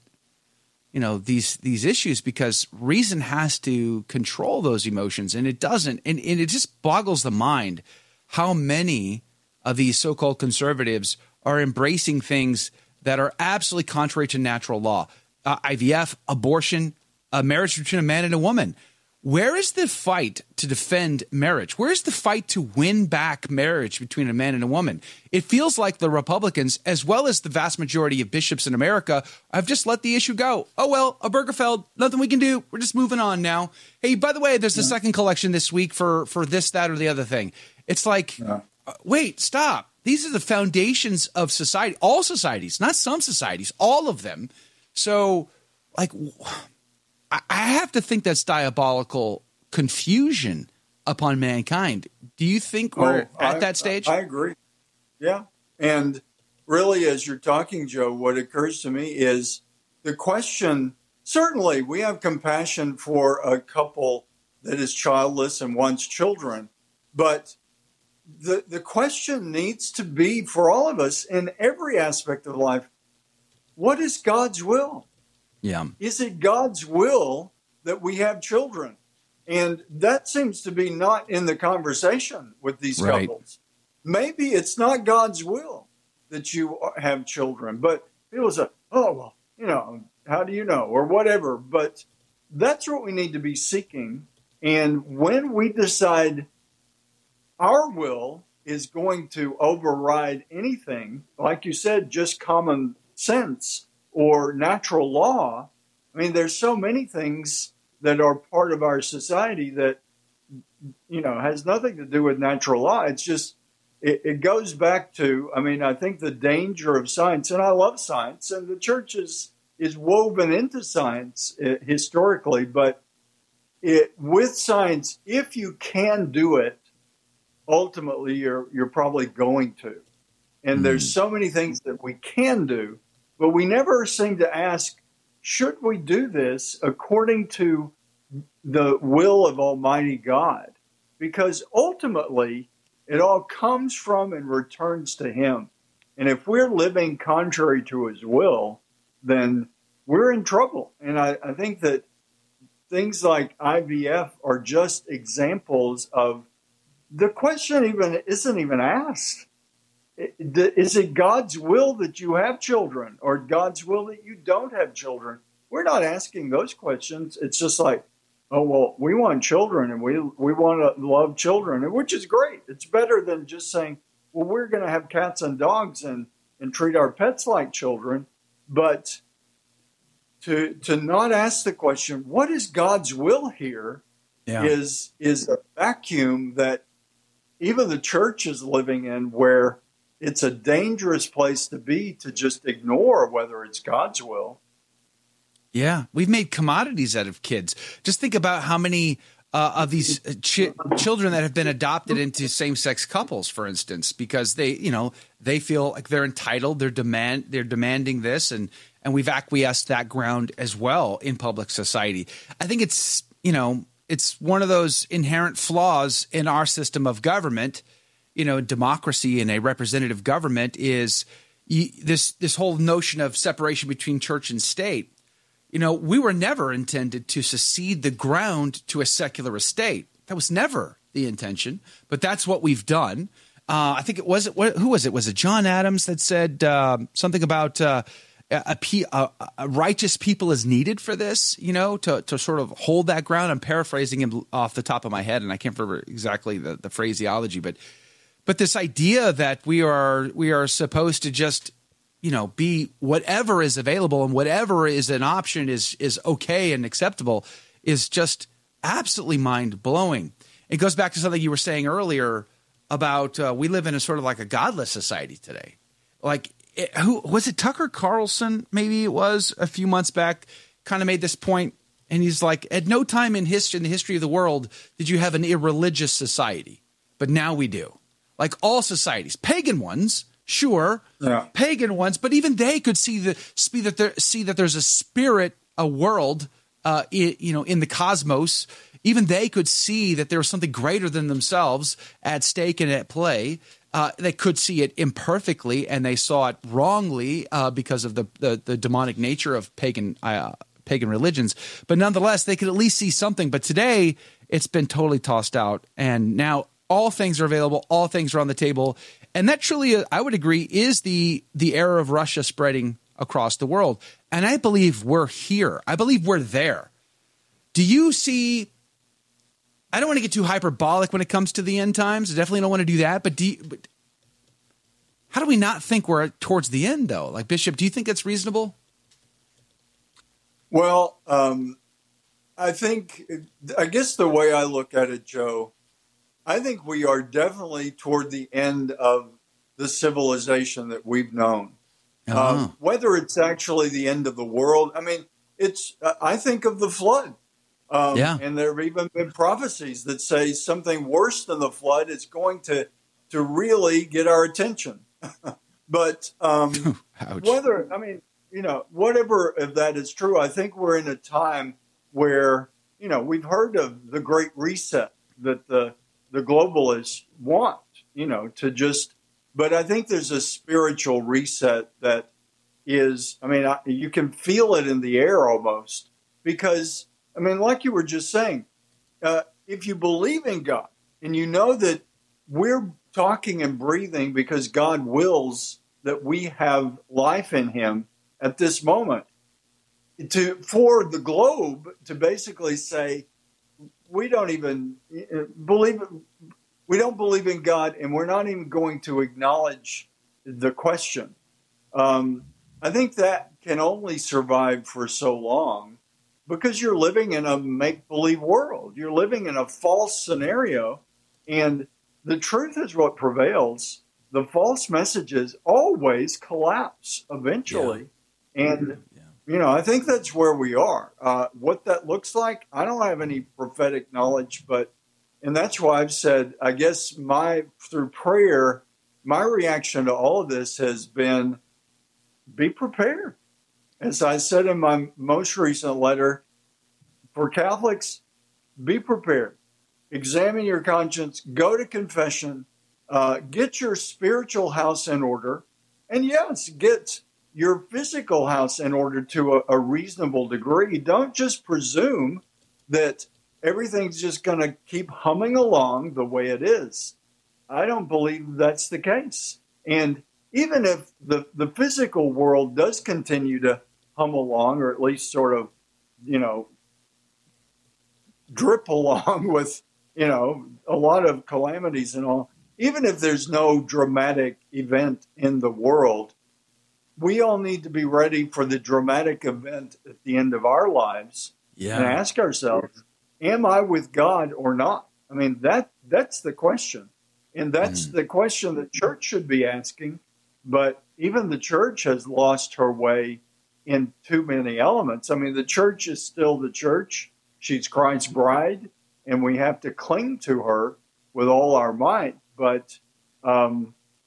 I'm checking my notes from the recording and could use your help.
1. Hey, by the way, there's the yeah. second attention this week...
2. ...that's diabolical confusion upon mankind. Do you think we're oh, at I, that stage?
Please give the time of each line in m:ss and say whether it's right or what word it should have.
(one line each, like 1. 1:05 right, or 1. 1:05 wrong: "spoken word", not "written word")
1. 0:34 wrong: "collection", not "attention"
2. 0:48 right.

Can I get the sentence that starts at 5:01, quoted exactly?
But nonetheless, they could at least see something.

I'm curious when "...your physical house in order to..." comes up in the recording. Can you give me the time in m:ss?
7:27.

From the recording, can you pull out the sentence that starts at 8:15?
I mean, the church is still the church.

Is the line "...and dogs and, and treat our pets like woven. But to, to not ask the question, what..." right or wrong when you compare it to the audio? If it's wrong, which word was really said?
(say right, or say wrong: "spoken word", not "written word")
wrong: "children", not "woven".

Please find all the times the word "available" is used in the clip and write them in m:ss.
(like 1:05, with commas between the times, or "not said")
4:13, 5:07.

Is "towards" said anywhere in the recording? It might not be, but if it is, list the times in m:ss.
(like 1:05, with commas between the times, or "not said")
5:26, 5:37.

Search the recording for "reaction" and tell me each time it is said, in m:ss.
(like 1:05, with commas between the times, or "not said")
7:09.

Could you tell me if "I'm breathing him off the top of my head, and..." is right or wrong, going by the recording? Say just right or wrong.
wrong.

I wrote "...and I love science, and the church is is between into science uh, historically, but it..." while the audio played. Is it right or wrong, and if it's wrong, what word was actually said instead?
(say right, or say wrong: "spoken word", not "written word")
wrong: "woven", not "between".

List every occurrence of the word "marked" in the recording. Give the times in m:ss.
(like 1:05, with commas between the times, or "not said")
not said.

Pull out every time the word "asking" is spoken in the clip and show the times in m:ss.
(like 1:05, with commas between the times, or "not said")
2:46, 8:09.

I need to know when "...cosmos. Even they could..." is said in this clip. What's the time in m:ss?
4:47.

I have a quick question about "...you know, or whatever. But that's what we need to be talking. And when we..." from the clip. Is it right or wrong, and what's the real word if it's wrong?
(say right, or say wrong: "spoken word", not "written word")
wrong: "seeking", not "talking".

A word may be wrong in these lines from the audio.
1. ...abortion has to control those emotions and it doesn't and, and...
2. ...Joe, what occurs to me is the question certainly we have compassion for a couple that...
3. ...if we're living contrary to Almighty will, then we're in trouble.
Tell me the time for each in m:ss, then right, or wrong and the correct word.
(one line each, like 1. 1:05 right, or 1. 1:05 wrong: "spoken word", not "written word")
1. 0:02 wrong: "reason", not "abortion"
2. 0:57 right
3. 2:26 wrong: "His", not "Almighty".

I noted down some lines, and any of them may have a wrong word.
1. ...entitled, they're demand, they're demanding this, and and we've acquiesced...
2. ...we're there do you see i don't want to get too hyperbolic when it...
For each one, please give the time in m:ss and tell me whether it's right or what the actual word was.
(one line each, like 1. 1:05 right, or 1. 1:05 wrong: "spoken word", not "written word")
1. 3:26 right
2. 5:16 right.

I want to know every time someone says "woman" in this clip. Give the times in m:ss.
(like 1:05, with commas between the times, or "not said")
0:18, 0:24.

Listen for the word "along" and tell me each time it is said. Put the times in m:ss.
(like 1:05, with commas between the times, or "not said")
7:35, 7:44, 7:48.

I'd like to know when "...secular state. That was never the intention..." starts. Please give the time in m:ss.
3:49.